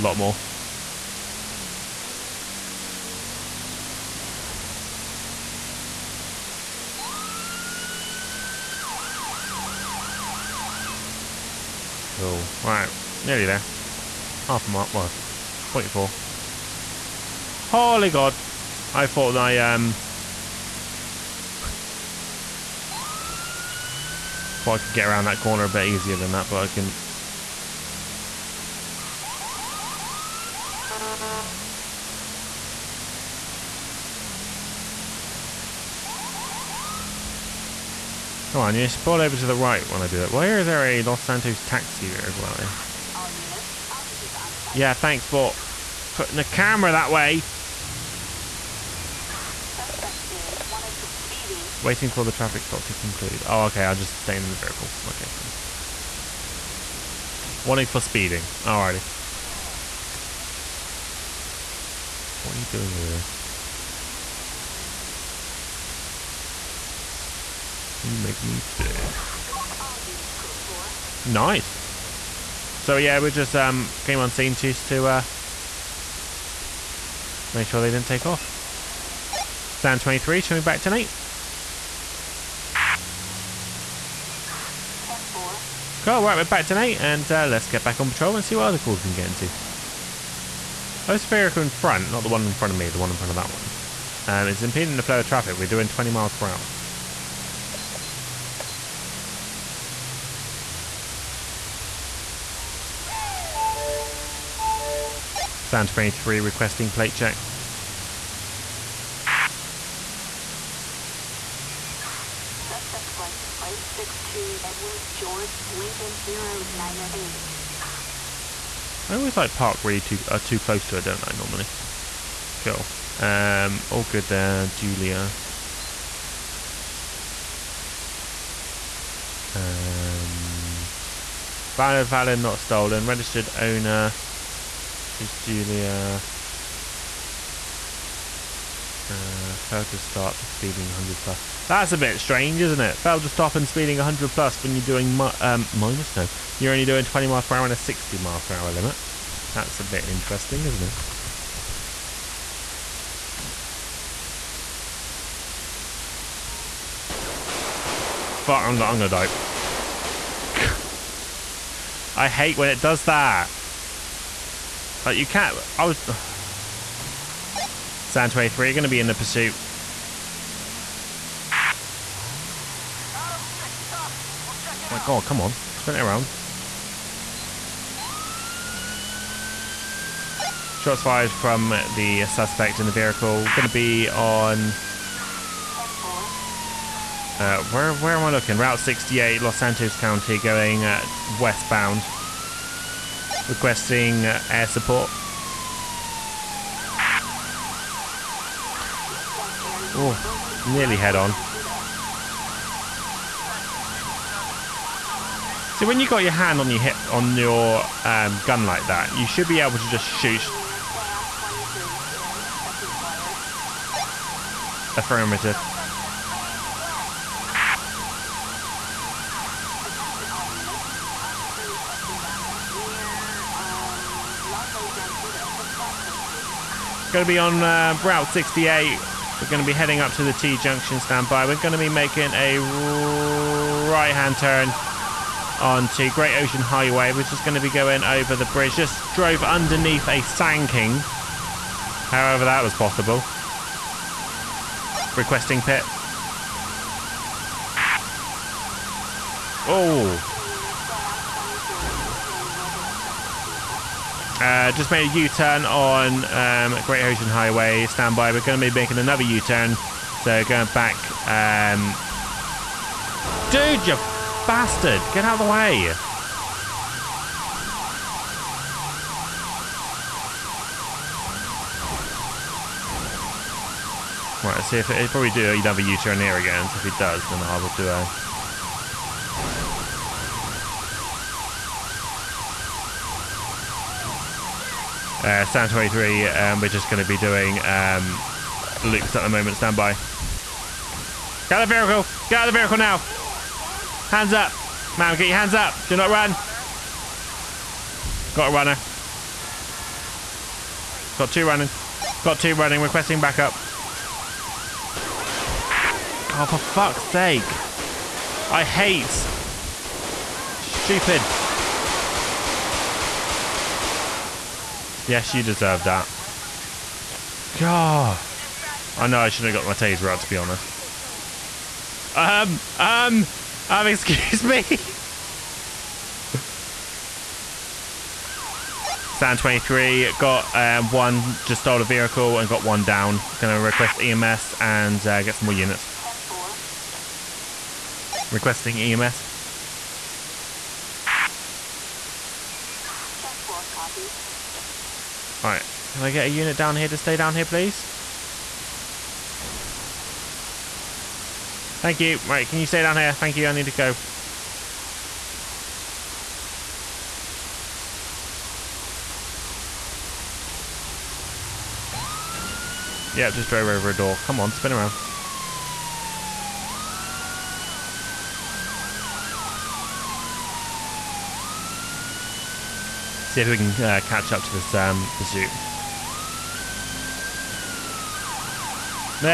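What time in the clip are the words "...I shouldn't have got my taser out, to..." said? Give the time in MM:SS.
05:19.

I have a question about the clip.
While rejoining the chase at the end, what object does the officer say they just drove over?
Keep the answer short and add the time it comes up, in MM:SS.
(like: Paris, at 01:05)
A door, at 06:03.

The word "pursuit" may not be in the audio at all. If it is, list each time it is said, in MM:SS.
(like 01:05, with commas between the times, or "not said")
02:49, 06:15.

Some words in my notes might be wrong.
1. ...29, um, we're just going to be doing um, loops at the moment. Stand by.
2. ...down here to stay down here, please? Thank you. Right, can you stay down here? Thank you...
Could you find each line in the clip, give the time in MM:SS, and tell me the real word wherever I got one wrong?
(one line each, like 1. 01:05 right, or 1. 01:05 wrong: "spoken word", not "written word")
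1. 04:45 wrong: "23", not "29"
2. 05:46 right.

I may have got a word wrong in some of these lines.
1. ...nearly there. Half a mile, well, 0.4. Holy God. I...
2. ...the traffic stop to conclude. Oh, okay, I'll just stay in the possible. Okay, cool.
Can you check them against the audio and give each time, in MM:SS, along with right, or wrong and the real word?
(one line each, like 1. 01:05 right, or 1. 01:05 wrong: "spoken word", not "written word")
1. 00:13 right
2. 00:52 wrong: "vehicle", not "possible".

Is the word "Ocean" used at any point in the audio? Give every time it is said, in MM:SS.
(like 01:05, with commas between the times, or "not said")
03:56, 04:17.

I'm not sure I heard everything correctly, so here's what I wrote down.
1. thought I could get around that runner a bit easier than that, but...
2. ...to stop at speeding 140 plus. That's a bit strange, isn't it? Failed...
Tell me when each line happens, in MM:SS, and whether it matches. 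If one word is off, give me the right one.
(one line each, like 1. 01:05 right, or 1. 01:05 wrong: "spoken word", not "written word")
1. 00:24 wrong: "corner", not "runner"
2. 02:19 wrong: "100", not "140".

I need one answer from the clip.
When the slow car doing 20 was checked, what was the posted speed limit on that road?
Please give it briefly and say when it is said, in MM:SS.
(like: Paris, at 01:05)
60 mph, at 02:27.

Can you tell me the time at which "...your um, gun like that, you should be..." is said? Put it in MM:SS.
03:27.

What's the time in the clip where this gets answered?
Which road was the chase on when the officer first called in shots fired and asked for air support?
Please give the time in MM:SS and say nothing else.
03:08.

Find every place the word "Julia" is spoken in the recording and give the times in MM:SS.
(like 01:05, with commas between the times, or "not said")
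02:04, 02:15.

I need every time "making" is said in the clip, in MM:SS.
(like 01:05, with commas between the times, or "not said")
03:51, 04:18.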